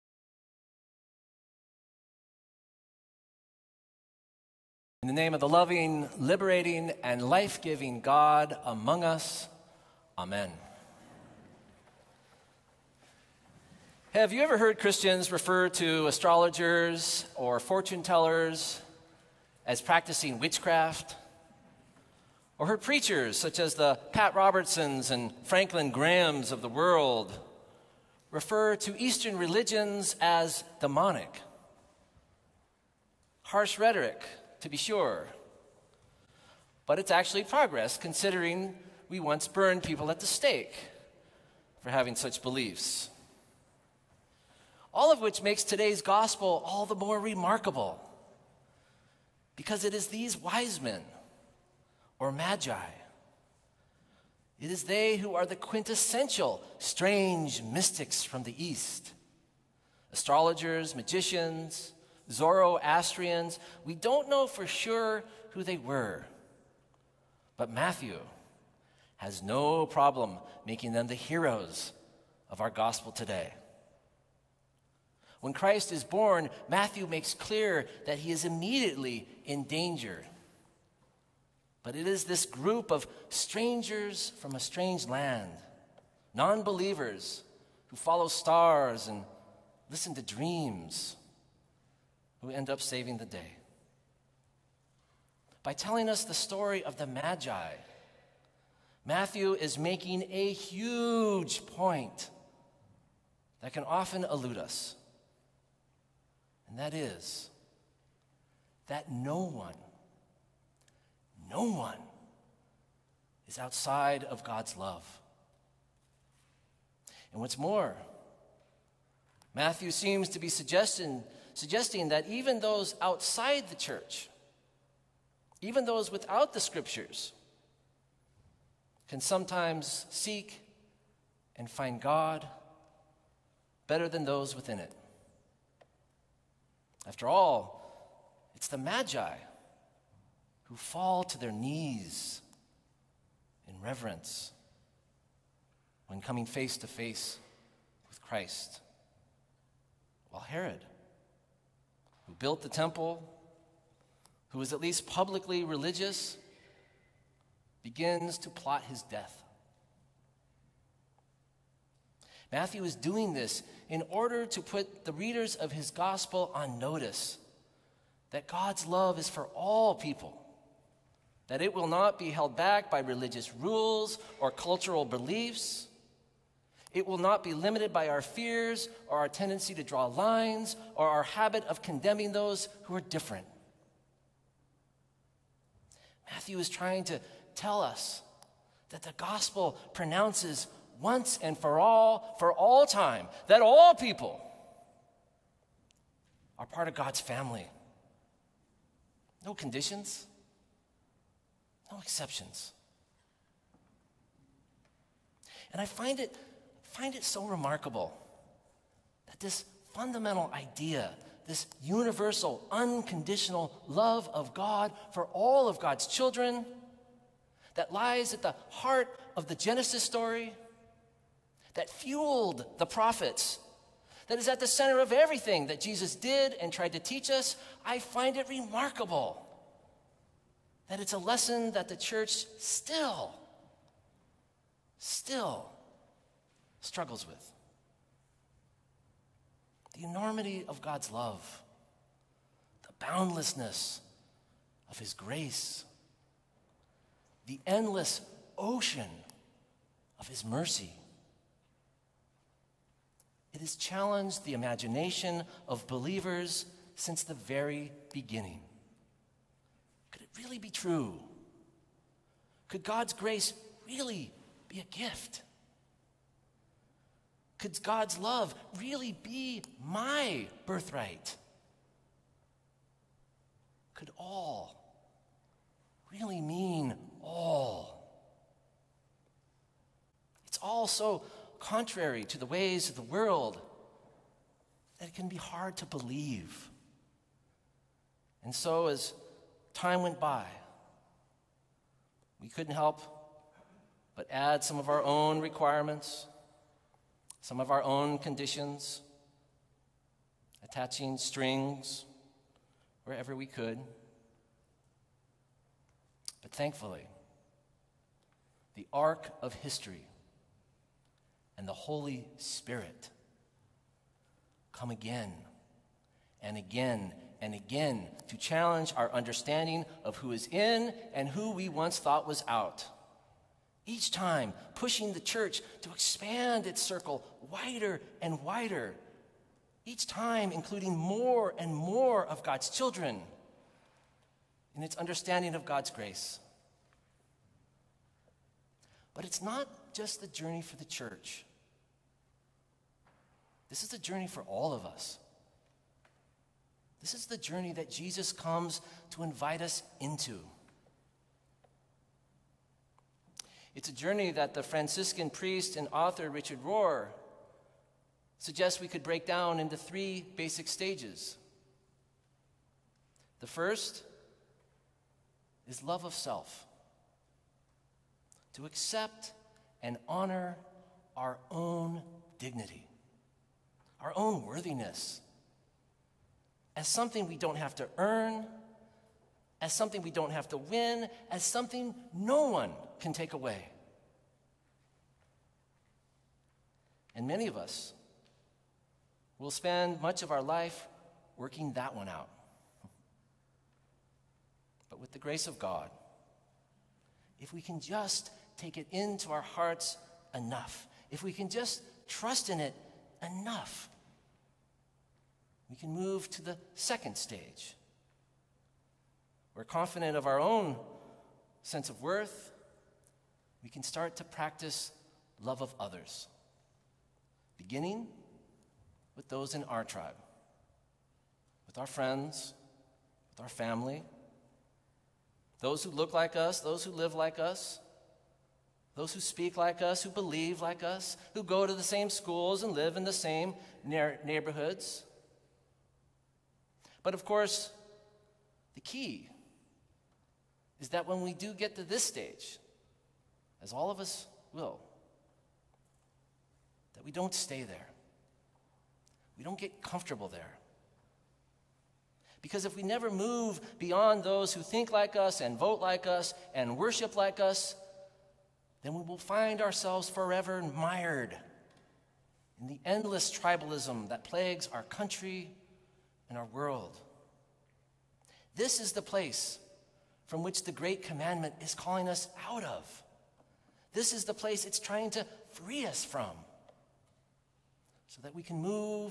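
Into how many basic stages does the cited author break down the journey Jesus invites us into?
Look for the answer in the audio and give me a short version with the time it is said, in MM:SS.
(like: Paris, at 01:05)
3, at 05:59.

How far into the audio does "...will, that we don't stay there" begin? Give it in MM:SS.
07:24.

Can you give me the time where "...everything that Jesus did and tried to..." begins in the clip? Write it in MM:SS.
03:45.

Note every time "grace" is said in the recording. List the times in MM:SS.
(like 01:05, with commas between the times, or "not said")
04:05, 04:23, 05:35, 06:35.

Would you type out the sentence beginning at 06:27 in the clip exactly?
And many of us will spend much of our life working that one out.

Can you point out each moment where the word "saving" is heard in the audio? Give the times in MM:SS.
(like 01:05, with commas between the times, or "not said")
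01:32.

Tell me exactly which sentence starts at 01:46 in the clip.
And that is that no one, no one is outside of God's love.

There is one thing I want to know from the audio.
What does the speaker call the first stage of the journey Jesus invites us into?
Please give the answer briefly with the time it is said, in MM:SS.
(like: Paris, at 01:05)
love of self, at 06:05.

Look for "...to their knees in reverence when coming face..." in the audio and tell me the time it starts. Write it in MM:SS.
02:21.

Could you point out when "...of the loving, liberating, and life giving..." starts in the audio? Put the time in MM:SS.
00:05.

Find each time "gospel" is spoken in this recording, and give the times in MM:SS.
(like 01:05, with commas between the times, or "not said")
00:46, 01:12, 02:45, 03:09.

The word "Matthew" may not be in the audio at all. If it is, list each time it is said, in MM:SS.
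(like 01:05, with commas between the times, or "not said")
01:07, 01:16, 01:39, 01:59, 02:42, 03:06.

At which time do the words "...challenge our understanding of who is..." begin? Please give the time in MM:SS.
05:18.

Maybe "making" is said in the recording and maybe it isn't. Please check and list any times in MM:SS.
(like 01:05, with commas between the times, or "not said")
01:10, 01:39.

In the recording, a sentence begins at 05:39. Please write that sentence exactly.
But it's not just the journey for the church.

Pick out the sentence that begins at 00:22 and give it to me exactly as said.
Or heard preachers such as the Pat Robertsons and Franklin Grahams of the world refer to Eastern religions as demonic?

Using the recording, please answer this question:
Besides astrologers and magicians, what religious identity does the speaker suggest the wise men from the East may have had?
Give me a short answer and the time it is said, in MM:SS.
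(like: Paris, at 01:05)
Zoroastrians, at 01:02.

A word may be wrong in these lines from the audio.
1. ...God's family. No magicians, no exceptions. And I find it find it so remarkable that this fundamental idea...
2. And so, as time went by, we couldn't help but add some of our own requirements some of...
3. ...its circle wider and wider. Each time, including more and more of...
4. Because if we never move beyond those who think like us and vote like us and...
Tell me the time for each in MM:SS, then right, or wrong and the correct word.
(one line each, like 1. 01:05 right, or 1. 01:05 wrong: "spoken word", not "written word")
1. 03:16 wrong: "conditions", not "magicians"
2. 04:48 right
3. 05:26 right
4. 07:32 right.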